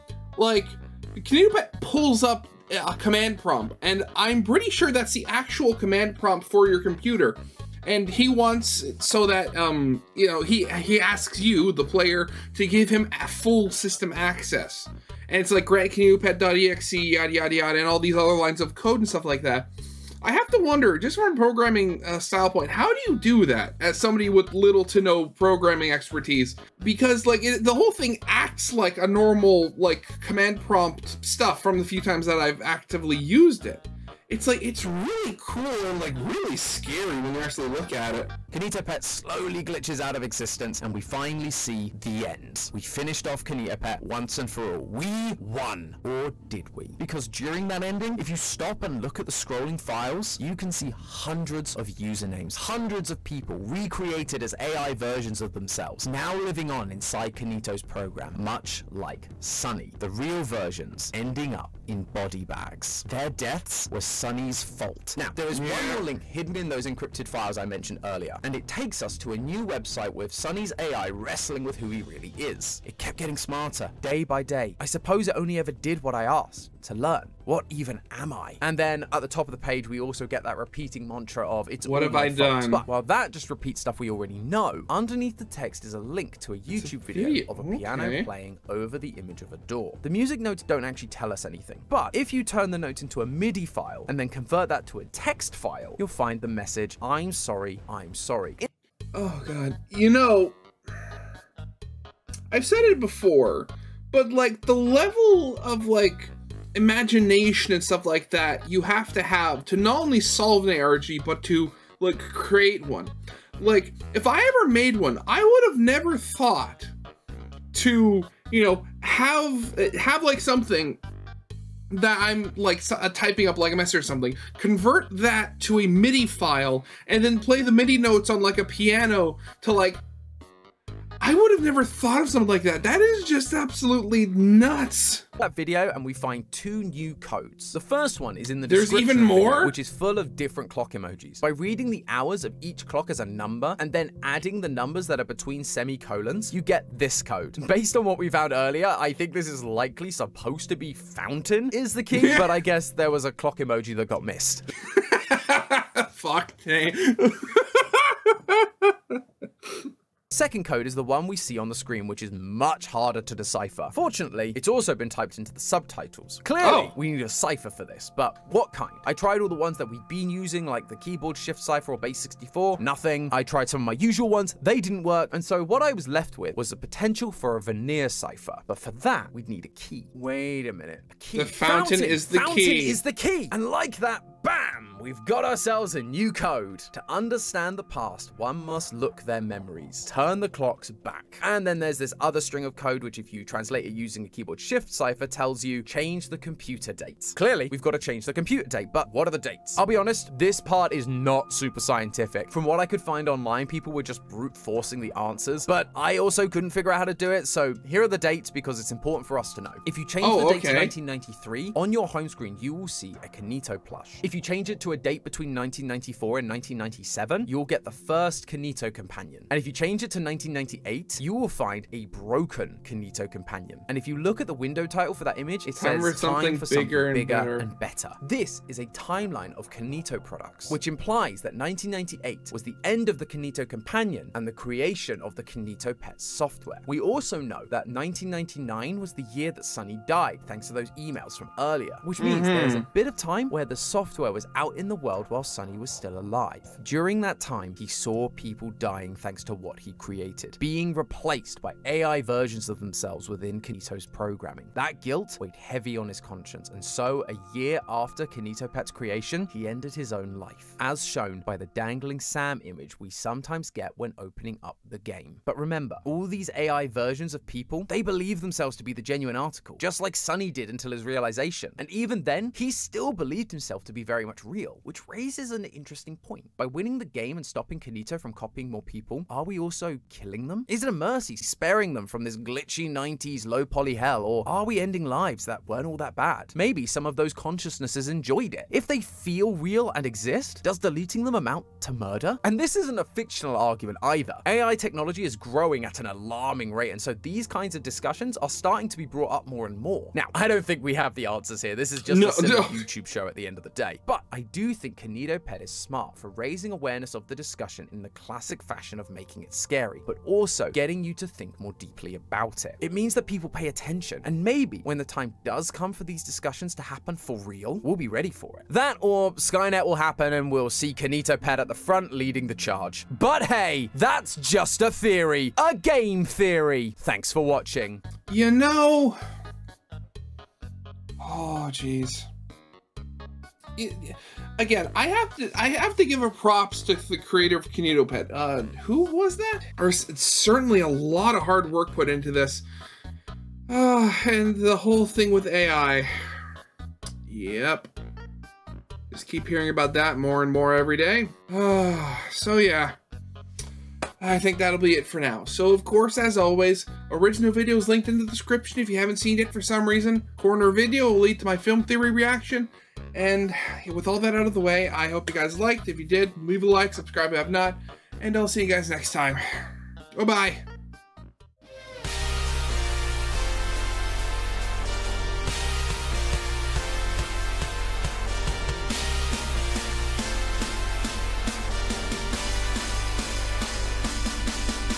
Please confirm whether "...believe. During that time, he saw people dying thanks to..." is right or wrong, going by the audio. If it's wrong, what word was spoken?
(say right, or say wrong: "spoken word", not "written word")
wrong: "alive", not "believe".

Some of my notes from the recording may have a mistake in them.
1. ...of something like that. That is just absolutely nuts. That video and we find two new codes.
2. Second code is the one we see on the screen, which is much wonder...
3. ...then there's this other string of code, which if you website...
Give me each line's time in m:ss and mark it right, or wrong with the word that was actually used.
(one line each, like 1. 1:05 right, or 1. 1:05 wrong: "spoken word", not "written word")
1. 2:12 right
2. 2:40 wrong: "harder", not "wonder"
3. 3:11 wrong: "translate", not "website".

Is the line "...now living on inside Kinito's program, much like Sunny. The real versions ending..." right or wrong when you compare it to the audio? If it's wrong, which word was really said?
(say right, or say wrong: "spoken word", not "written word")
right.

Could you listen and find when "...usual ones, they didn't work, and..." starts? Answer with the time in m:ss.
2:54.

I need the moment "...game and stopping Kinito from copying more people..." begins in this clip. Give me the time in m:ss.
4:37.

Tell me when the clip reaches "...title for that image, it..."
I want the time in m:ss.
3:44.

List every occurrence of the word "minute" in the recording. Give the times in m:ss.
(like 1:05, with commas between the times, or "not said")
3:00.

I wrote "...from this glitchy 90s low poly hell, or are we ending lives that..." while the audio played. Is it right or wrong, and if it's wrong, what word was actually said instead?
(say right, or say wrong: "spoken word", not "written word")
right.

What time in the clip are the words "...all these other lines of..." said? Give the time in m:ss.
0:17.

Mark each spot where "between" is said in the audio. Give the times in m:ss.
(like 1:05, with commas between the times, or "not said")
2:25, 3:35.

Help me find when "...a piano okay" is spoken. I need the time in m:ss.
1:27.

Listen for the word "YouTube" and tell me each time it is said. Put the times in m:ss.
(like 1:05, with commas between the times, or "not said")
1:26, 5:02.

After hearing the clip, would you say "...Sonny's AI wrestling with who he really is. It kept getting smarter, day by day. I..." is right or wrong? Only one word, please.
right.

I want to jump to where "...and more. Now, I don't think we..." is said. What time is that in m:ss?
4:59.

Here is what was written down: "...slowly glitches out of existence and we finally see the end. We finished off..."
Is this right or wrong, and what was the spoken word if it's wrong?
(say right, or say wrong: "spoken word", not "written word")
right.